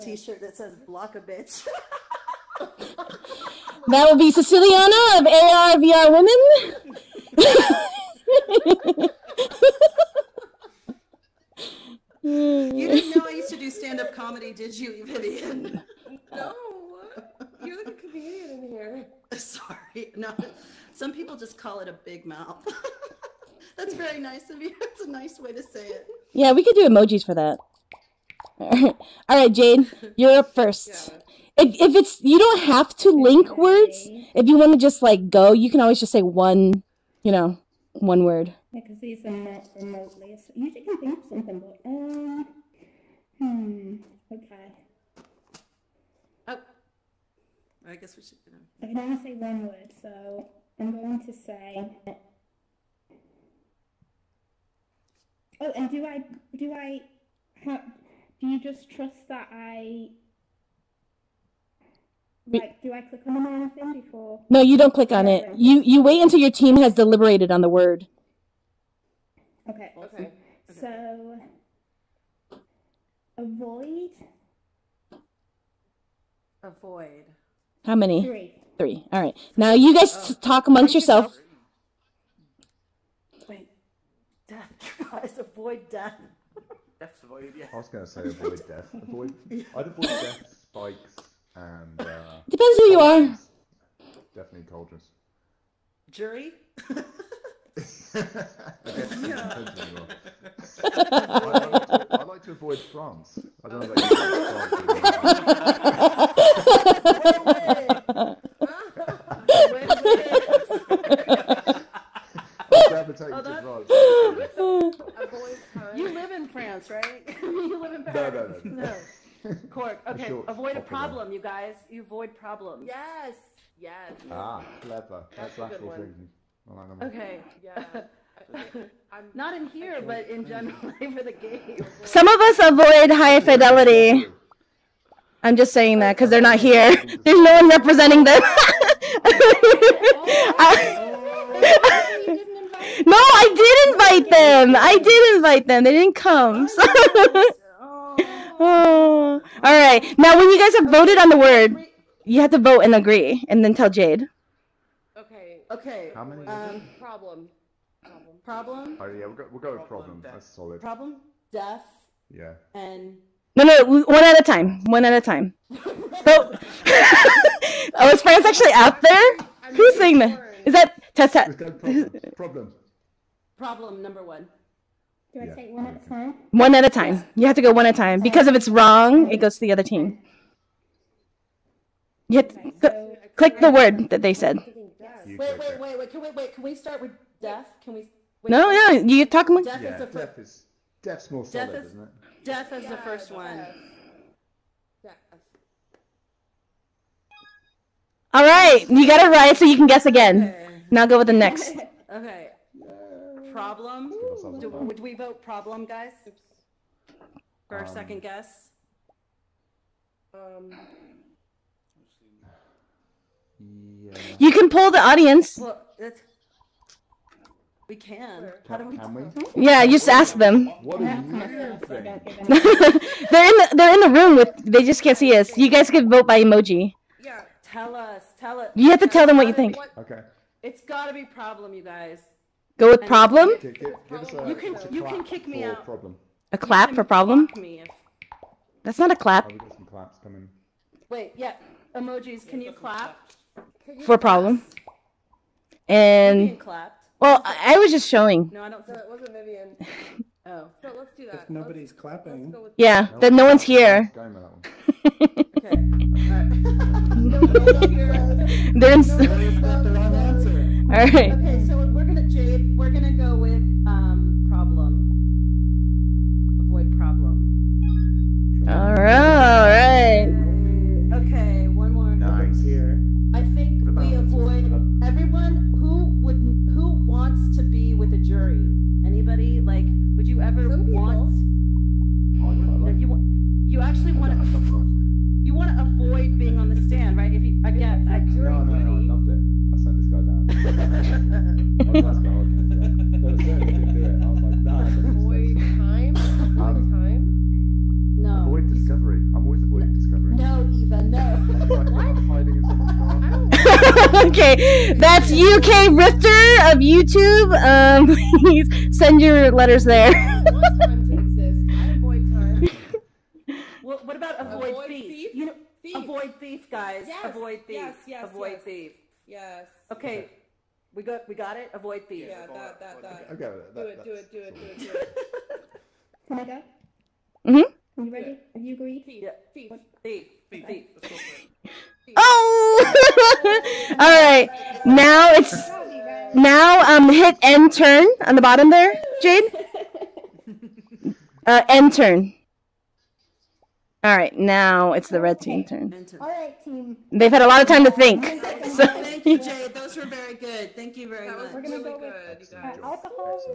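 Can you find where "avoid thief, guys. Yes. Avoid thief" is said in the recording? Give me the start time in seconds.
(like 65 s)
315 s.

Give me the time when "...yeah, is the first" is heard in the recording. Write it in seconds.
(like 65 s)
189 s.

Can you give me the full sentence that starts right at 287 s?
If you again, if like no, no, no, I loved it.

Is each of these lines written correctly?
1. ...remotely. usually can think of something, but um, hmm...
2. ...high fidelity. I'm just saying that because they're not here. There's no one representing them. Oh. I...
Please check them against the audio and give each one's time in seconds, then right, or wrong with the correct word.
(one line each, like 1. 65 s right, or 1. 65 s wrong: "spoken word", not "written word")
1. 39 s right
2. 133 s right.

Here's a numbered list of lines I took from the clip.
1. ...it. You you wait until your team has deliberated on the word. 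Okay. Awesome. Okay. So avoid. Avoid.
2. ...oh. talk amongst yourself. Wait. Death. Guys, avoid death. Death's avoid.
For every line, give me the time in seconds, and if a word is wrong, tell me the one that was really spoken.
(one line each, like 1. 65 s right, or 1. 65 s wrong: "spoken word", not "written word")
1. 65 s right
2. 80 s right.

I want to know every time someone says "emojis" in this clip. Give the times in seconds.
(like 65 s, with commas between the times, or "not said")
26 s, 226 s, 241 s.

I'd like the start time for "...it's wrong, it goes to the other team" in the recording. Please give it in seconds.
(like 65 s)
178 s.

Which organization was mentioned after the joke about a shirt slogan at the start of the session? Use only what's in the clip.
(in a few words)
ARVR Women.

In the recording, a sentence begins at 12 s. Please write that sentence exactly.
you didn't know I used to do stand up comedy, did you, Vivian?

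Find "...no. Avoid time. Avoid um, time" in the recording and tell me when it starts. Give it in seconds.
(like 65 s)
294 s.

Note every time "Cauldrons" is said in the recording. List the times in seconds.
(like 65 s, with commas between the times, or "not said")
94 s.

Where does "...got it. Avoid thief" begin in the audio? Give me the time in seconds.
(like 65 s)
321 s.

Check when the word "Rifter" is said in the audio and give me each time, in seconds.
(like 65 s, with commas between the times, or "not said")
305 s.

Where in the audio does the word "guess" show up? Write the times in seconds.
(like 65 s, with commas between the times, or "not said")
47 s, 199 s, 208 s.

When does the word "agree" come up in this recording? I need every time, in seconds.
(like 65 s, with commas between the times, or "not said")
152 s, 328 s.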